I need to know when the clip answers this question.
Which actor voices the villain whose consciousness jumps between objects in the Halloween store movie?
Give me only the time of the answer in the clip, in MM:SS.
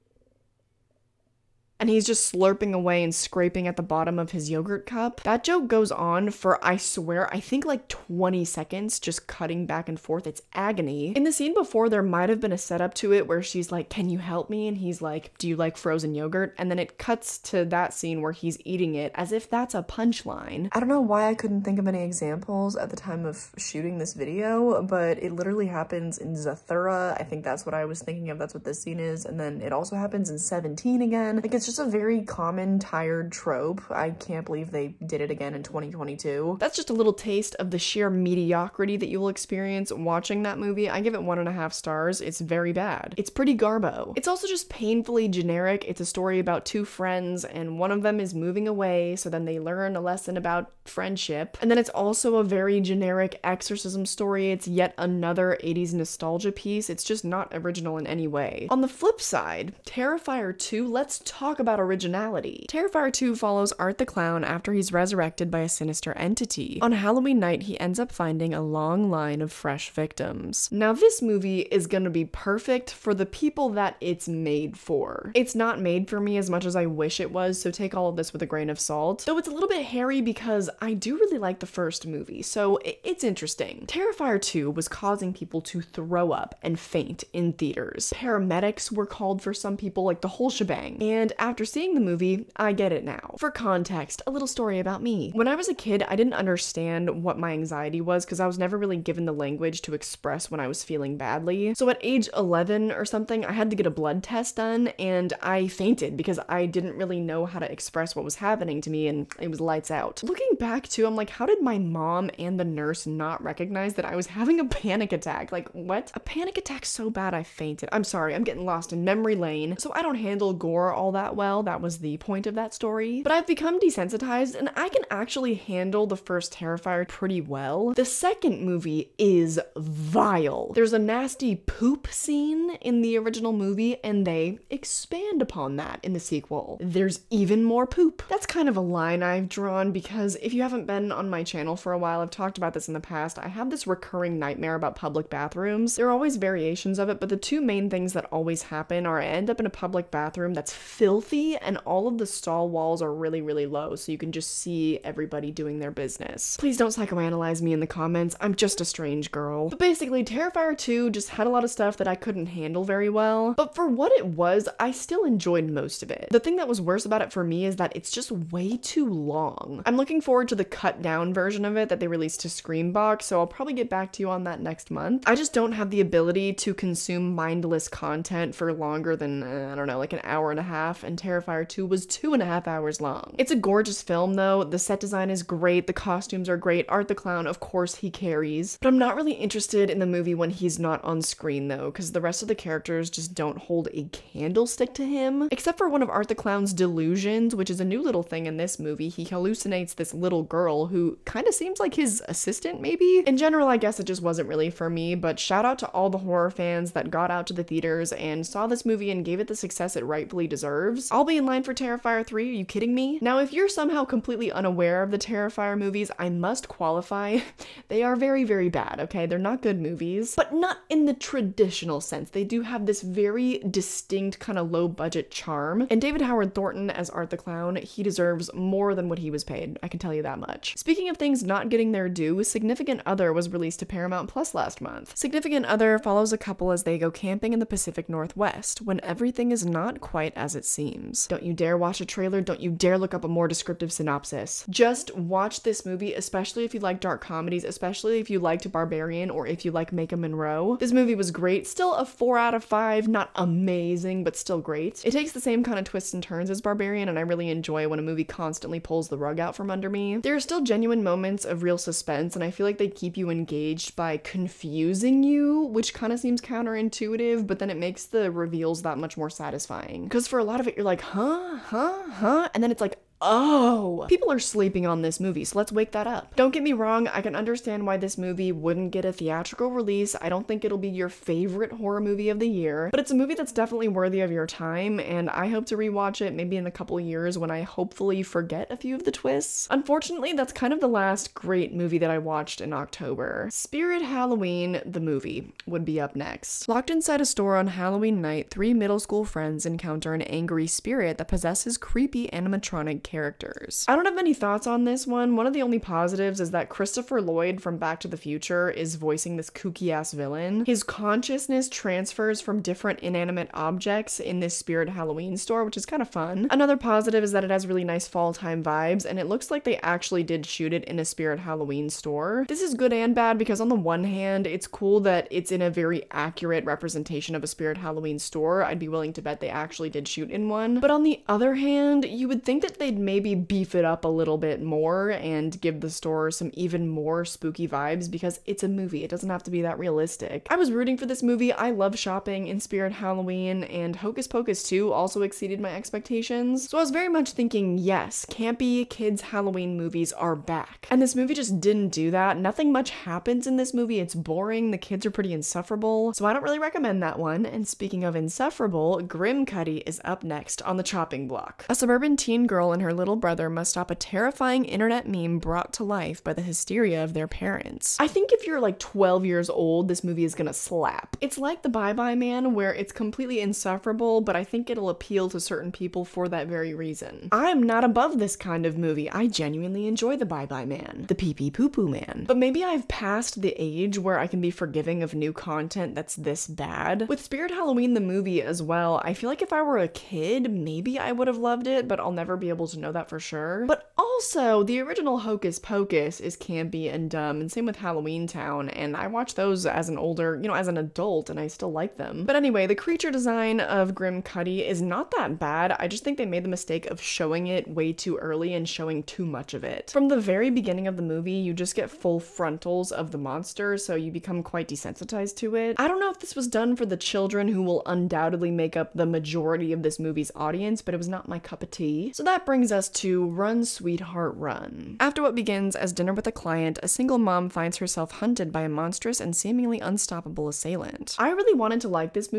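05:06.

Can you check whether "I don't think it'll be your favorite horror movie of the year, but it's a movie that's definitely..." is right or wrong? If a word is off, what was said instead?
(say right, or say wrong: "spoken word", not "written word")
right.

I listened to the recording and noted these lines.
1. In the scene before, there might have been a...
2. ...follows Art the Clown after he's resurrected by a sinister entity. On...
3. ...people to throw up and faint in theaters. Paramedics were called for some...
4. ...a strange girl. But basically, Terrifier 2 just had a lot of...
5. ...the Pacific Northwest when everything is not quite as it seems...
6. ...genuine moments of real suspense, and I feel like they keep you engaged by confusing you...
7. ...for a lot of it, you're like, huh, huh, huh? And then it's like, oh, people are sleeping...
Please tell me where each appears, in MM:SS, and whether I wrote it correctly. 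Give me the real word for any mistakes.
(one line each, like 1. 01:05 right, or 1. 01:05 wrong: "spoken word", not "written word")
1. 00:11 right
2. 01:03 right
3. 01:25 right
4. 02:38 right
5. 03:57 right
6. 04:20 right
7. 04:30 right.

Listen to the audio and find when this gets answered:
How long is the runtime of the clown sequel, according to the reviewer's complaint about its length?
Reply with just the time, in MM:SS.
03:02.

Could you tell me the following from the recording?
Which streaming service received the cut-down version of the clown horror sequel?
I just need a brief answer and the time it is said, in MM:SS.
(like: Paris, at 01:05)
Screambox, at 02:52.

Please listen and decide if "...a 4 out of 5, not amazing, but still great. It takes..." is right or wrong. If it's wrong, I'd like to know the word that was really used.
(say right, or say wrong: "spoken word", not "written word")
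right.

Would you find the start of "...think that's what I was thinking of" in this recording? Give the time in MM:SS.
00:27.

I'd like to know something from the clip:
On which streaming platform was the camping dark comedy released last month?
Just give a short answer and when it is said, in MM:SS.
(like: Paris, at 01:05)
Paramount Plus, at 03:53.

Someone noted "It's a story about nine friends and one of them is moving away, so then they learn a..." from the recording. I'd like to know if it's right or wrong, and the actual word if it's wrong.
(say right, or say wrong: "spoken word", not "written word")
wrong: "two", not "nine".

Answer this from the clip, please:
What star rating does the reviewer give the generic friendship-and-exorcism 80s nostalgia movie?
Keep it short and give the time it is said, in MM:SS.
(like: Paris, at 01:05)
1.5 stars, at 00:41.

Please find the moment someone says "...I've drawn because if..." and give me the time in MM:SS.
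02:19.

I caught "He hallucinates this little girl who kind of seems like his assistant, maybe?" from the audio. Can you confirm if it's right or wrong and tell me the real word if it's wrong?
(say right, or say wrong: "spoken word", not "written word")
right.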